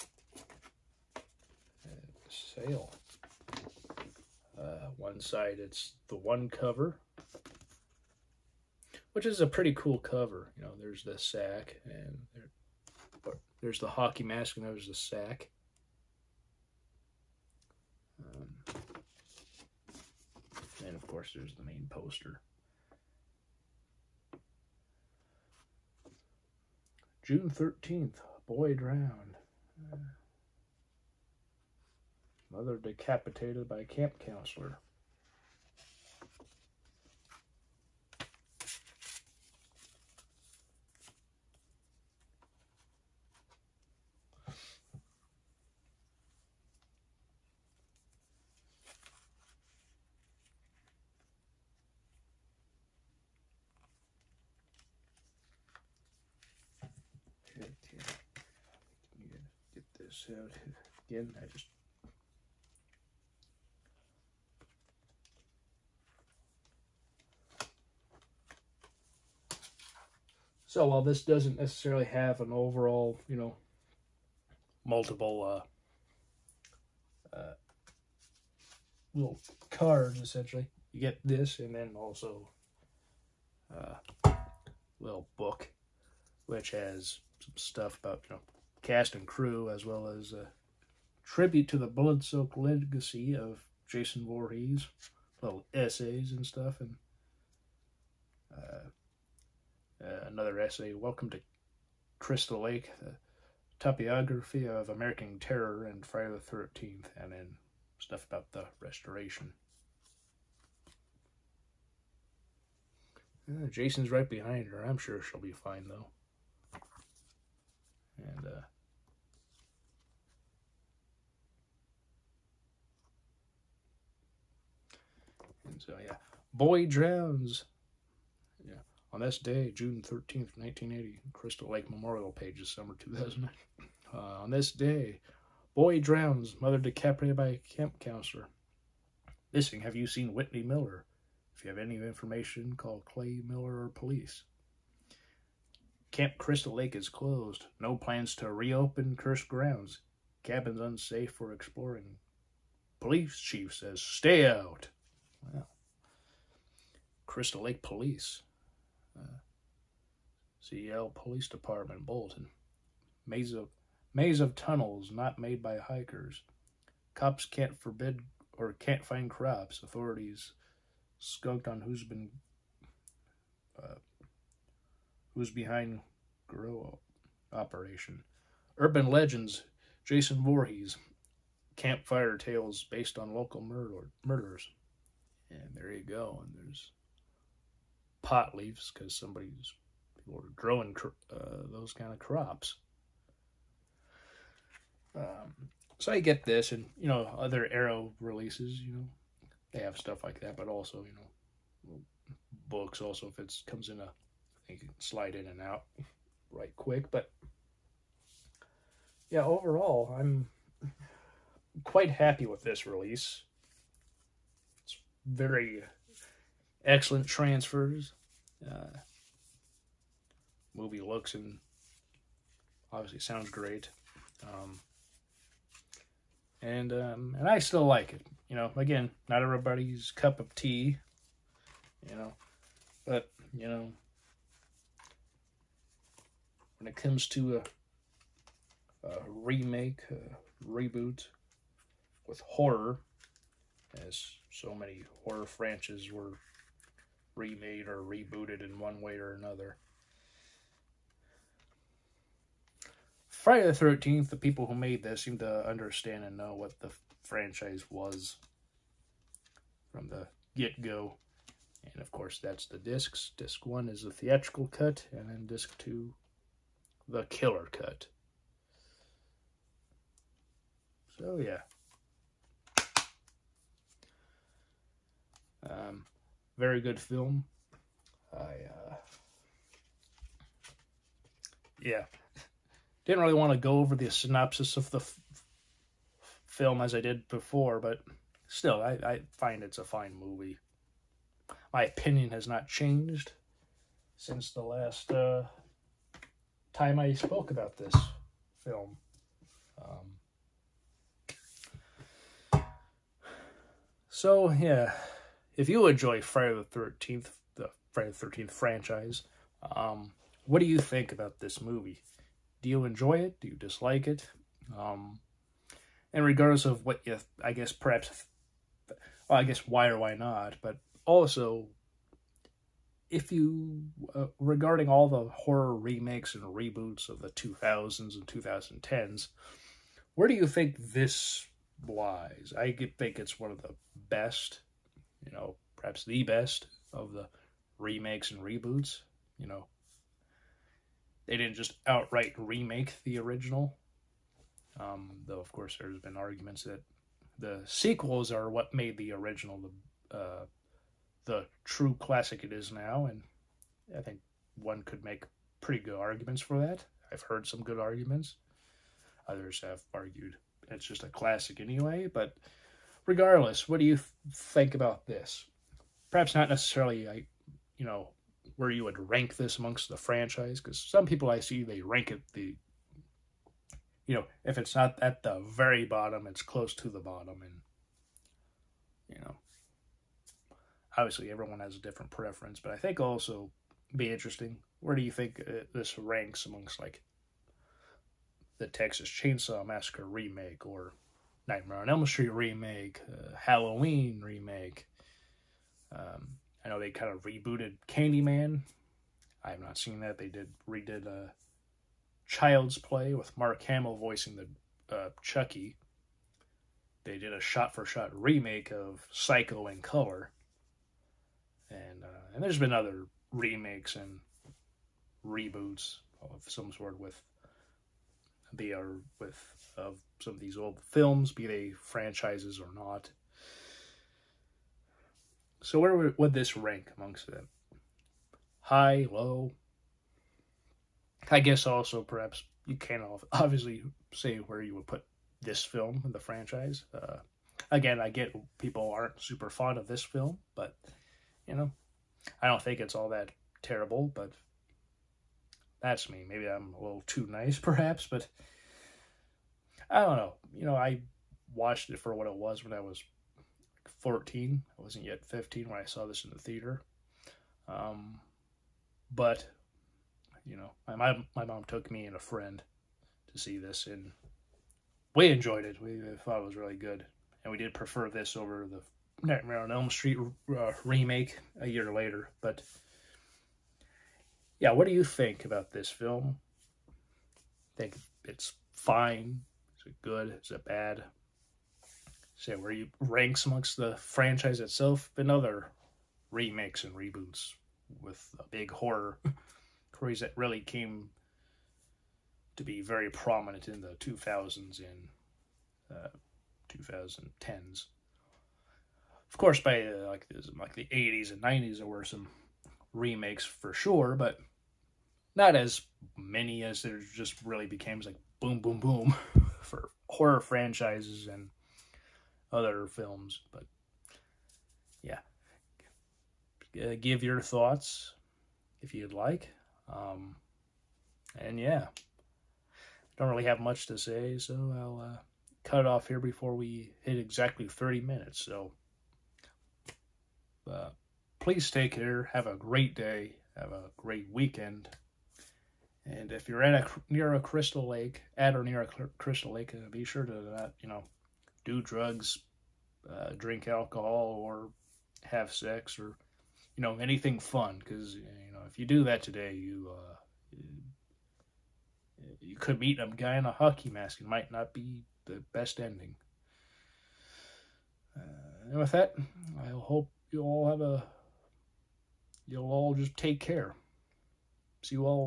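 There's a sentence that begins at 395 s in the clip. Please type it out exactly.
Um, I know they kind of rebooted Candyman.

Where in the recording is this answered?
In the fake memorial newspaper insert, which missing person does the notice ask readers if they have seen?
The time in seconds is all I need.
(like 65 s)
140 s.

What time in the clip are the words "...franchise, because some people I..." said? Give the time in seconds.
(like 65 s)
369 s.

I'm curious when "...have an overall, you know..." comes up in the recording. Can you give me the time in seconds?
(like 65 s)
72 s.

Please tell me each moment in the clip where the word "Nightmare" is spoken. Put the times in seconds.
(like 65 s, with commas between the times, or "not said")
391 s, 469 s.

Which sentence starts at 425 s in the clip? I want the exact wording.
So where would this rank amongst them?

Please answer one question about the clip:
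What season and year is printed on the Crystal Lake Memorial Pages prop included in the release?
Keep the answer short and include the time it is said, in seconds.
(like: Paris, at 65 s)
Summer 2000, at 132 s.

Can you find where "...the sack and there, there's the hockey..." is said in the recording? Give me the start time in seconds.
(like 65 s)
11 s.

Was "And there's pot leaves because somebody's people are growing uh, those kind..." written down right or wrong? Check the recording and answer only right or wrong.
right.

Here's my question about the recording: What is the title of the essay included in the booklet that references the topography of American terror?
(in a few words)
Welcome to Crystal Lake.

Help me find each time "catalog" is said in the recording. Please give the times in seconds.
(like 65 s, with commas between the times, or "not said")
not said.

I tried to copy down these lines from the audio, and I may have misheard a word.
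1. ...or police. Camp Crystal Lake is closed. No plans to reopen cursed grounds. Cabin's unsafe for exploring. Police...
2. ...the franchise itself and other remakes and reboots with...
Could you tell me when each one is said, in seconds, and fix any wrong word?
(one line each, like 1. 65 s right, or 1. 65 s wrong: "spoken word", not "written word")
1. 143 s right
2. 483 s right.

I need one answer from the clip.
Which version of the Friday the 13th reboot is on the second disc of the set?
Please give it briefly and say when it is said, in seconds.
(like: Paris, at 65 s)
The killer cut, at 267 s.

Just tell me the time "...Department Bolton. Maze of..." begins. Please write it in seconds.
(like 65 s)
161 s.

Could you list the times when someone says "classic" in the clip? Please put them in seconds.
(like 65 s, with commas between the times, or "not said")
351 s, 361 s.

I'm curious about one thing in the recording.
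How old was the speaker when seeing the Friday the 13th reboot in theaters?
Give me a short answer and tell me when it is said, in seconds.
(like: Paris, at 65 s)
14, at 453 s.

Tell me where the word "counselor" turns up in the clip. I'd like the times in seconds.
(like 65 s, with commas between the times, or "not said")
34 s, 137 s.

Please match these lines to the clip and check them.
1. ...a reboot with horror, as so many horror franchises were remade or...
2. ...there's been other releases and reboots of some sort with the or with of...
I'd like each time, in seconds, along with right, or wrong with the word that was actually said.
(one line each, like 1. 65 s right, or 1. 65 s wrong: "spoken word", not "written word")
1. 240 s right
2. 412 s wrong: "remakes", not "releases".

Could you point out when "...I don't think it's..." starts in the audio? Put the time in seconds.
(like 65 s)
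442 s.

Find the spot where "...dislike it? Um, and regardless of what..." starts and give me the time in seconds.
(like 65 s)
313 s.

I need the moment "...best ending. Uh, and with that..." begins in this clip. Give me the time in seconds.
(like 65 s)
555 s.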